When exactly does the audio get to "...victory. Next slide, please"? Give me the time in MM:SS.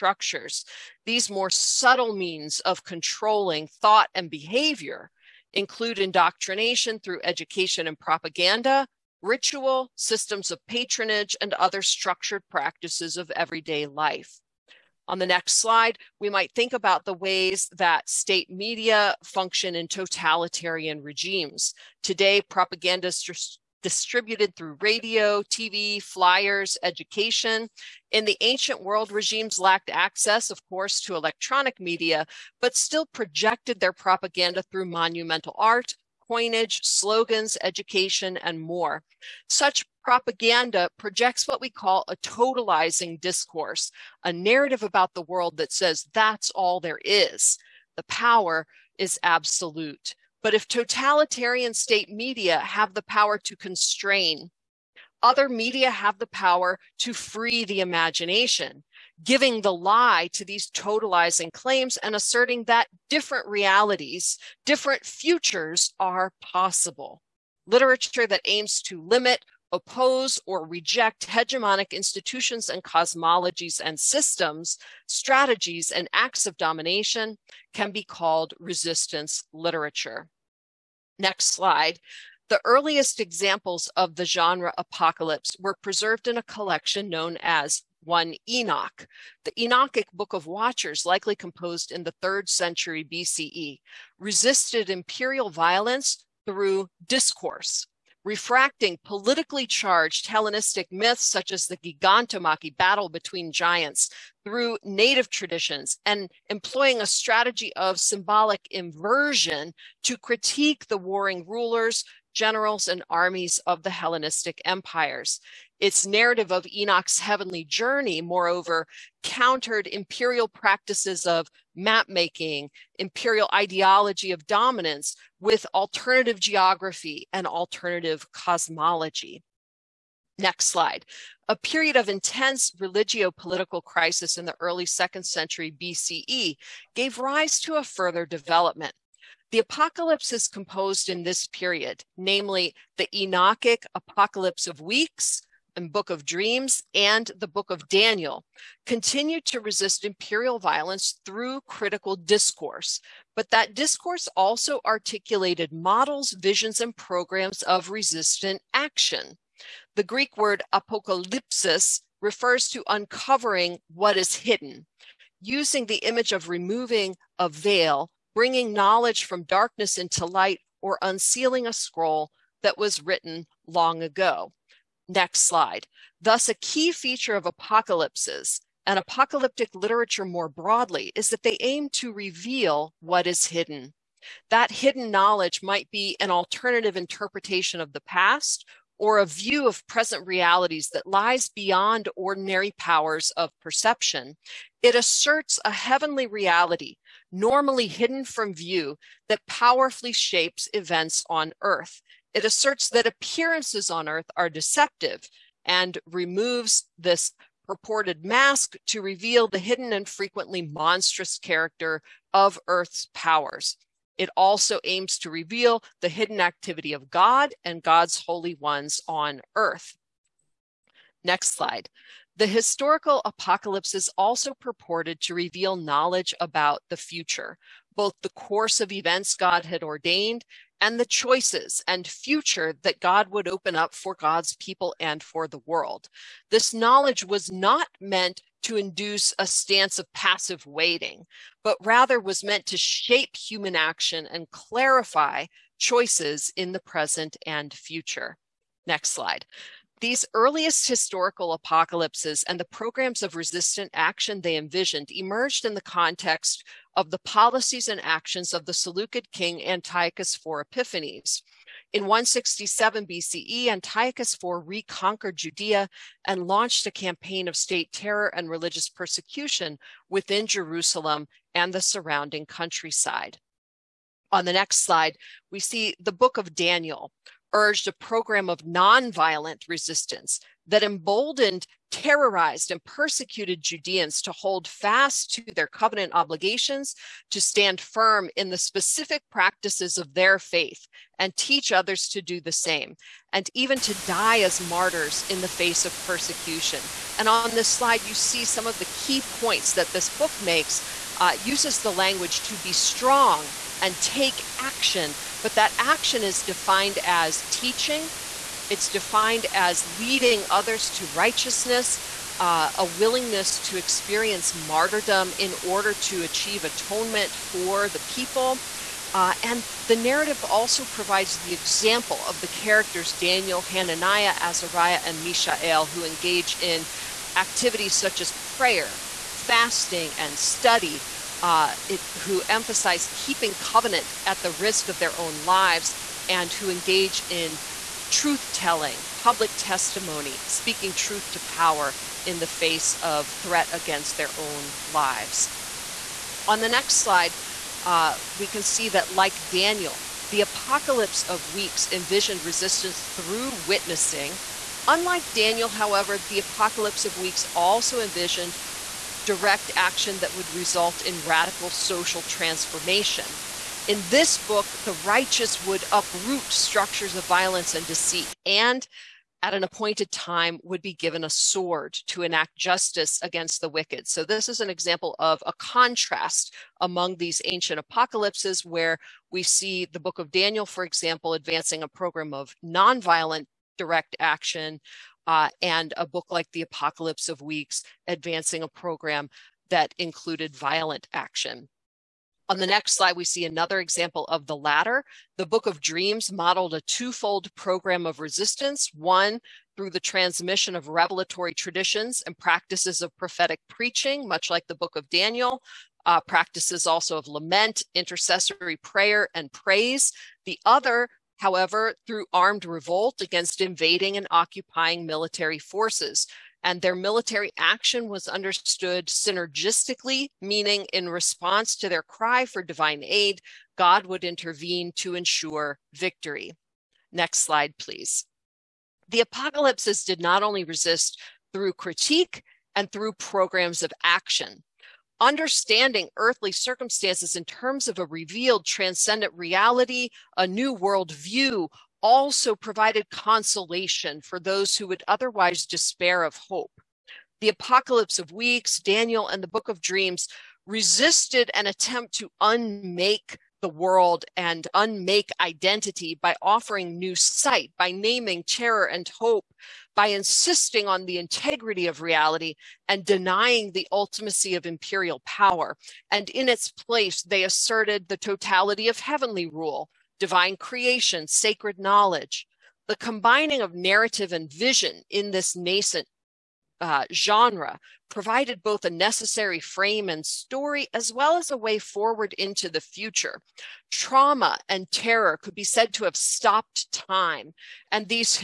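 07:05.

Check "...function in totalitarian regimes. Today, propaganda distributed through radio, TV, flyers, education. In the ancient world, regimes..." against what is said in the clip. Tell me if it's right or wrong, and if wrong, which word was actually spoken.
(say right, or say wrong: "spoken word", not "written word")
right.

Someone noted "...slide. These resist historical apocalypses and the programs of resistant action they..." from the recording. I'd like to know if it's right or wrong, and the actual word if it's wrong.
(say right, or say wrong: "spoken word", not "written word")
wrong: "earliest", not "resist".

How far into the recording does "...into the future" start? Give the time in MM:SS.
08:02.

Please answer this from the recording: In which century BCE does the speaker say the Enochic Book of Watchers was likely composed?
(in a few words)
3rd century BCE.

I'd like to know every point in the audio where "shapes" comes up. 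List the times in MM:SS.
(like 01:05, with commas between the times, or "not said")
03:20, 04:02.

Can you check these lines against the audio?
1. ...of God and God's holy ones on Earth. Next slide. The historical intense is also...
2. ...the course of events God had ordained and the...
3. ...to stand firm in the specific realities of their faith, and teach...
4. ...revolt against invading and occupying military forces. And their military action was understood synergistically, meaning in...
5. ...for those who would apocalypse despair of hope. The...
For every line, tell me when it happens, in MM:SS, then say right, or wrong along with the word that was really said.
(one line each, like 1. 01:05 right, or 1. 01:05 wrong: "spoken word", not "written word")
1. 03:36 wrong: "apocalypse", not "intense"
2. 03:48 right
3. 04:47 wrong: "practices", not "realities"
4. 06:52 right
5. 07:24 wrong: "otherwise", not "apocalypse".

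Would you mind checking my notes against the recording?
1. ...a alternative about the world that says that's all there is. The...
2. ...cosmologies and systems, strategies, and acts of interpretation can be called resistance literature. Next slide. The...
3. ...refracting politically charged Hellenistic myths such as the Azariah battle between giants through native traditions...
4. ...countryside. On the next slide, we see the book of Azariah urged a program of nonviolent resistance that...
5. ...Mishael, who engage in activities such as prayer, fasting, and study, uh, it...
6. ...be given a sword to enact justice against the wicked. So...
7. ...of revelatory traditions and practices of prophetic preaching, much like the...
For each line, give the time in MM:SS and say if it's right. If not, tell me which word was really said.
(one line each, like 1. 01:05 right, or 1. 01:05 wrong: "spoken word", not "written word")
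1. 00:44 wrong: "narrative", not "alternative"
2. 01:12 wrong: "domination", not "interpretation"
3. 01:38 wrong: "Gigantomachy", not "Azariah"
4. 04:32 wrong: "Daniel", not "Azariah"
5. 05:25 right
6. 06:10 right
7. 06:40 right.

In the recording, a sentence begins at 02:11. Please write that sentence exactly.
A period of intense religio political crisis in the early second century BCE gave rise to a further development.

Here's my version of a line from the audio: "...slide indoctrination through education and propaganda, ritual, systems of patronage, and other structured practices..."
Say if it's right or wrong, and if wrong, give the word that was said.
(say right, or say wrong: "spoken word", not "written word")
wrong: "include", not "slide".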